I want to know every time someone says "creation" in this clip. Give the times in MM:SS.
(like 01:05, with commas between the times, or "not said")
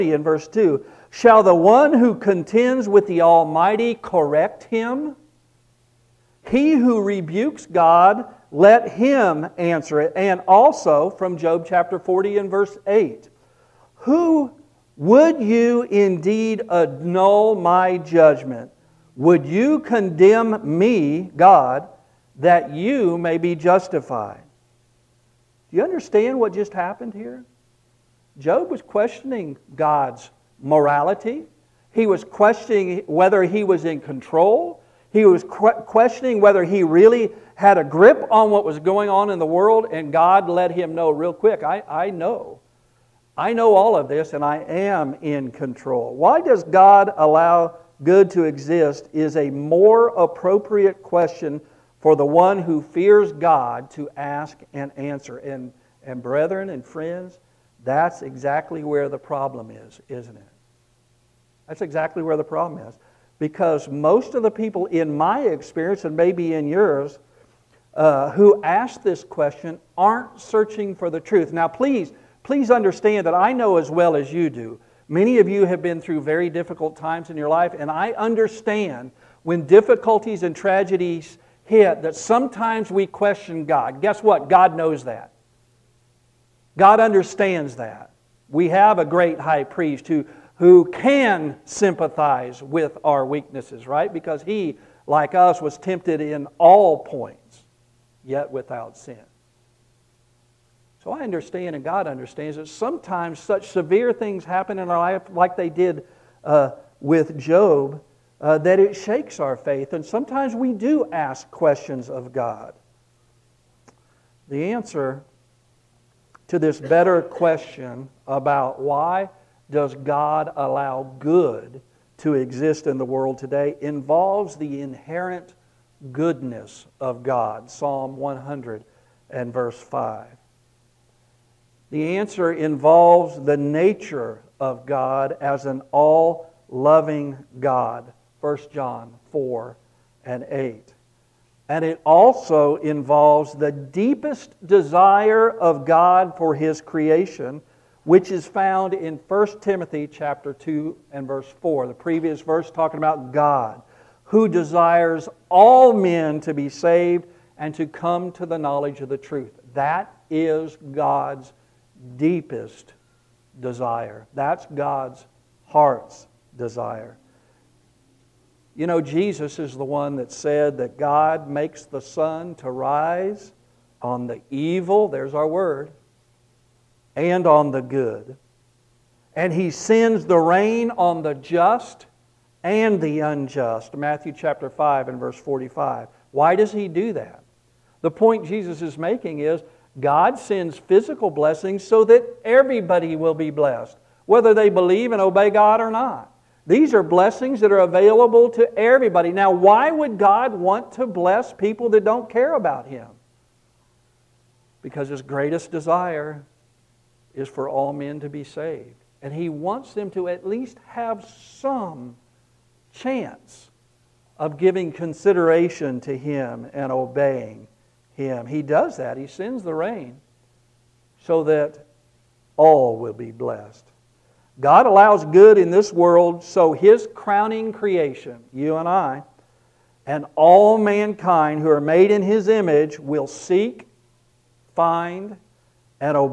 02:26, 03:47.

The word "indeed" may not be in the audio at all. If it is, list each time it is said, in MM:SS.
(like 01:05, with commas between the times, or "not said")
00:15.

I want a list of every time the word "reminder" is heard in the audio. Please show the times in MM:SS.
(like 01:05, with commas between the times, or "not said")
not said.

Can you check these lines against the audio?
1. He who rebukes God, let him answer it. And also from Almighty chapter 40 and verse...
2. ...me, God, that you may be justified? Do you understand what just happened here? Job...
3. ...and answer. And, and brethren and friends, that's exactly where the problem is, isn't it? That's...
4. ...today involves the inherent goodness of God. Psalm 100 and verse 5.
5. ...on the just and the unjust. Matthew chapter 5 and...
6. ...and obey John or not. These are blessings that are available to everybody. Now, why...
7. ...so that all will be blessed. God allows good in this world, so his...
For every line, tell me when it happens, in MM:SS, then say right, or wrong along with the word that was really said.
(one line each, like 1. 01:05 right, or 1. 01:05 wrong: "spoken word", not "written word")
1. 00:06 wrong: "Job", not "Almighty"
2. 00:20 right
3. 00:54 right
4. 02:03 right
5. 03:00 right
6. 03:15 wrong: "God", not "John"
7. 03:41 right.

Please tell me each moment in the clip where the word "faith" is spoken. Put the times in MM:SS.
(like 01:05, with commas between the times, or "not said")
01:49.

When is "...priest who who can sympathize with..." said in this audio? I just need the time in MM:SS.
01:29.